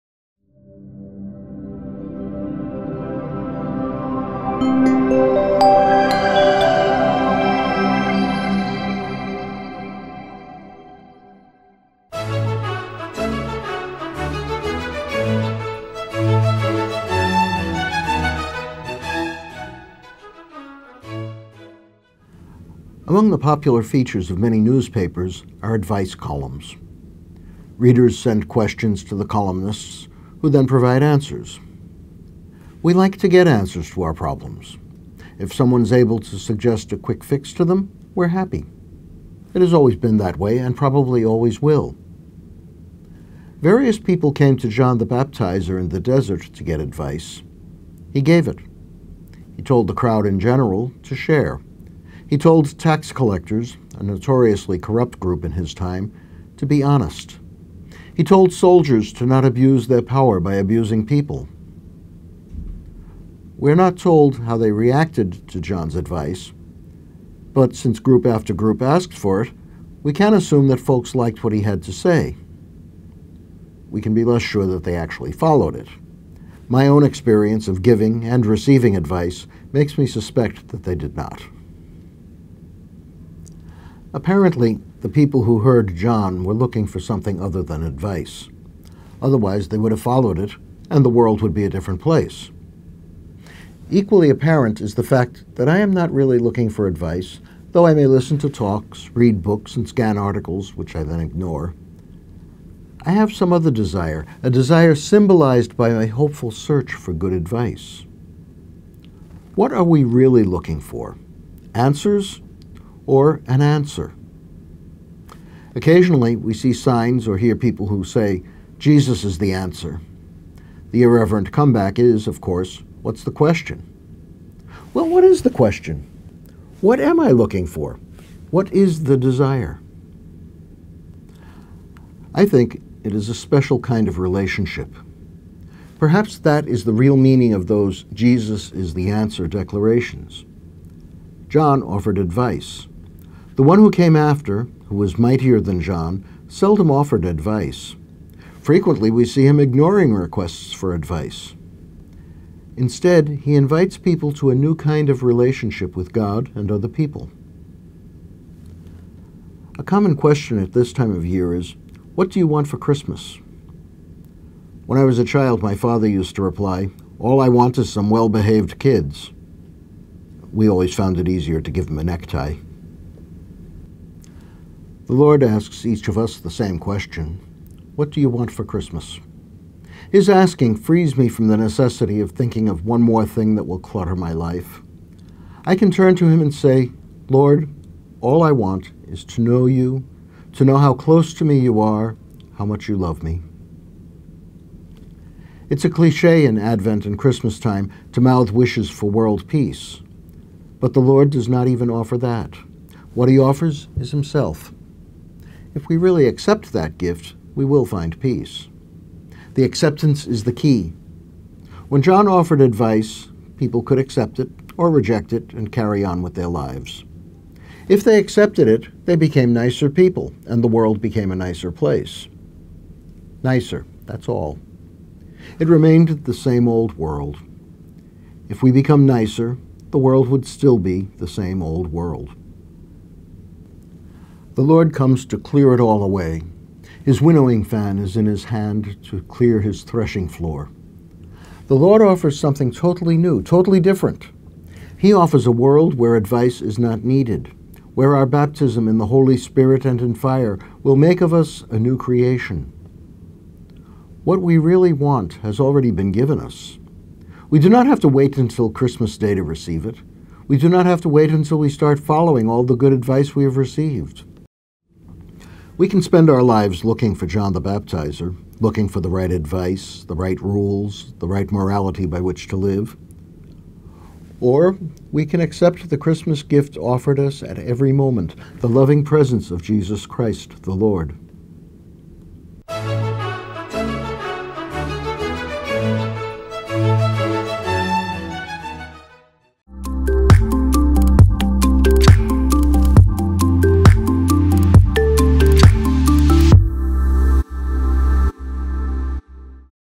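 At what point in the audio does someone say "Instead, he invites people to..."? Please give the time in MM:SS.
02:32.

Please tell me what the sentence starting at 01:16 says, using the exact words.
My own experience of giving and receiving advice makes me suspect that they did not.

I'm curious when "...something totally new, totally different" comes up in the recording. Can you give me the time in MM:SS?
04:02.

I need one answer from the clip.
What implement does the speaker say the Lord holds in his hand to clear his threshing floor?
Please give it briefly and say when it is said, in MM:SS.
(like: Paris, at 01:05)
Winnowing fan, at 03:57.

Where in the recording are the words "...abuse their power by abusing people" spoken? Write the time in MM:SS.
00:59.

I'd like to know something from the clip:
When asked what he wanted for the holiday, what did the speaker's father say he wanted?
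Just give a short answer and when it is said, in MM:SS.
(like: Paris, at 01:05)
Well behaved kids, at 02:48.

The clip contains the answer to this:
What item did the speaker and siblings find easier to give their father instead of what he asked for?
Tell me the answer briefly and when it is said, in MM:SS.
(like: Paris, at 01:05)
A necktie, at 02:52.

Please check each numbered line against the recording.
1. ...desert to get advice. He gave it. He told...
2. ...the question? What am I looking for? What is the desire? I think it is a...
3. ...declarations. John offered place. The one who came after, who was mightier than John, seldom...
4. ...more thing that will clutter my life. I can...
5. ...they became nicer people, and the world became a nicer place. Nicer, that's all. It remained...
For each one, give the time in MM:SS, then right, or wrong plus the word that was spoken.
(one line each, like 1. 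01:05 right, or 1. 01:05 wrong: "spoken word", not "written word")
1. 00:45 right
2. 02:05 right
3. 02:19 wrong: "advice", not "place"
4. 03:03 right
5. 03:39 right.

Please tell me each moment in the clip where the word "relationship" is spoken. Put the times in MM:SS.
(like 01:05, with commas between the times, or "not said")
02:14, 02:35.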